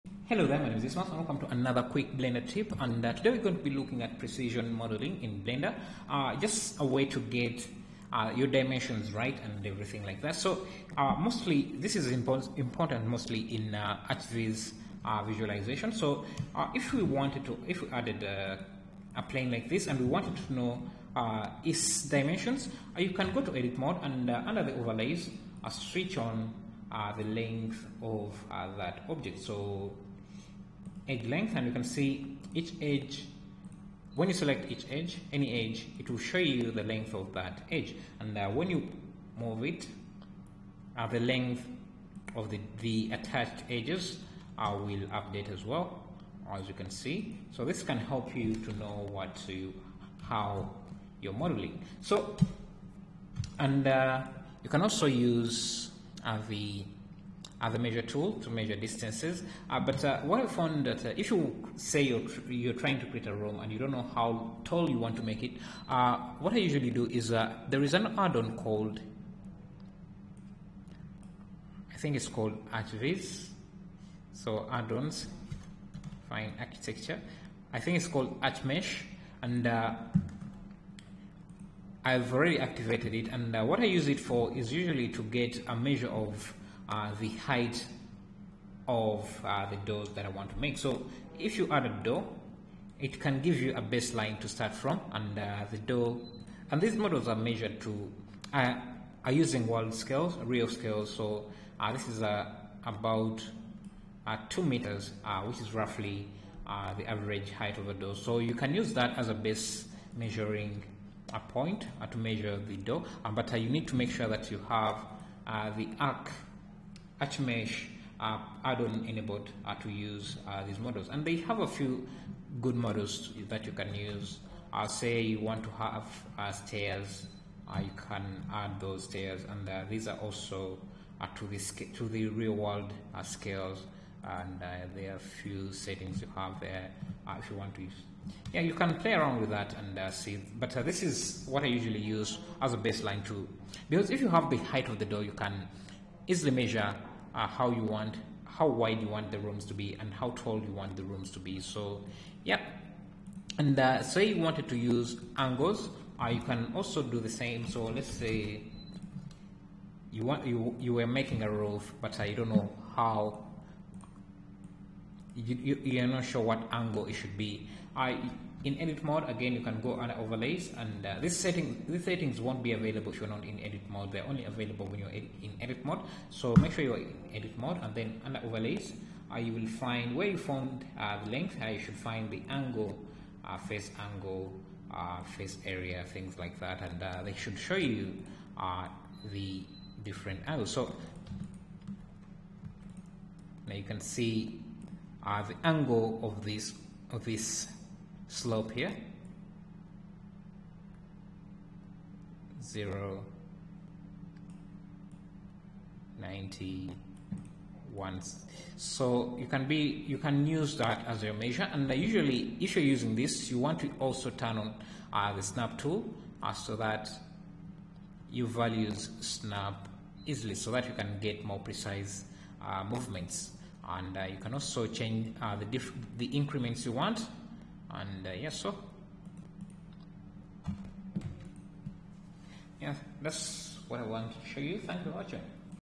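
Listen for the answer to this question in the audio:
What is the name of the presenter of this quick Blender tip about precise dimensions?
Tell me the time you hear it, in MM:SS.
00:00.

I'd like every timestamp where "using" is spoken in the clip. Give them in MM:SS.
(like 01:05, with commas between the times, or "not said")
01:39, 03:32.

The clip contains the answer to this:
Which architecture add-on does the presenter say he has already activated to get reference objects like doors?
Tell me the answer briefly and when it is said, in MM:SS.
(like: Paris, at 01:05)
ArchMesh, at 01:18.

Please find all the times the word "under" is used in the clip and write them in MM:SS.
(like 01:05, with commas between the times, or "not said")
00:24, 02:49, 02:58.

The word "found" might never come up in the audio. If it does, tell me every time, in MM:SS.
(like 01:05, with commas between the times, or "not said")
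01:00, 03:00.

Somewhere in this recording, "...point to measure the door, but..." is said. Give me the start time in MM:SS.
01:51.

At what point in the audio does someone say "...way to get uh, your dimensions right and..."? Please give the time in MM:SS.
00:06.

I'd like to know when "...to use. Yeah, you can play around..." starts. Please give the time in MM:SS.
02:17.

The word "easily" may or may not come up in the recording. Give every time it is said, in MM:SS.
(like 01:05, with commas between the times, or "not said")
02:26, 03:40.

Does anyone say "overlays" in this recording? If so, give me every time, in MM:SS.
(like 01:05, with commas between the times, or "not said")
00:24, 02:50, 02:58.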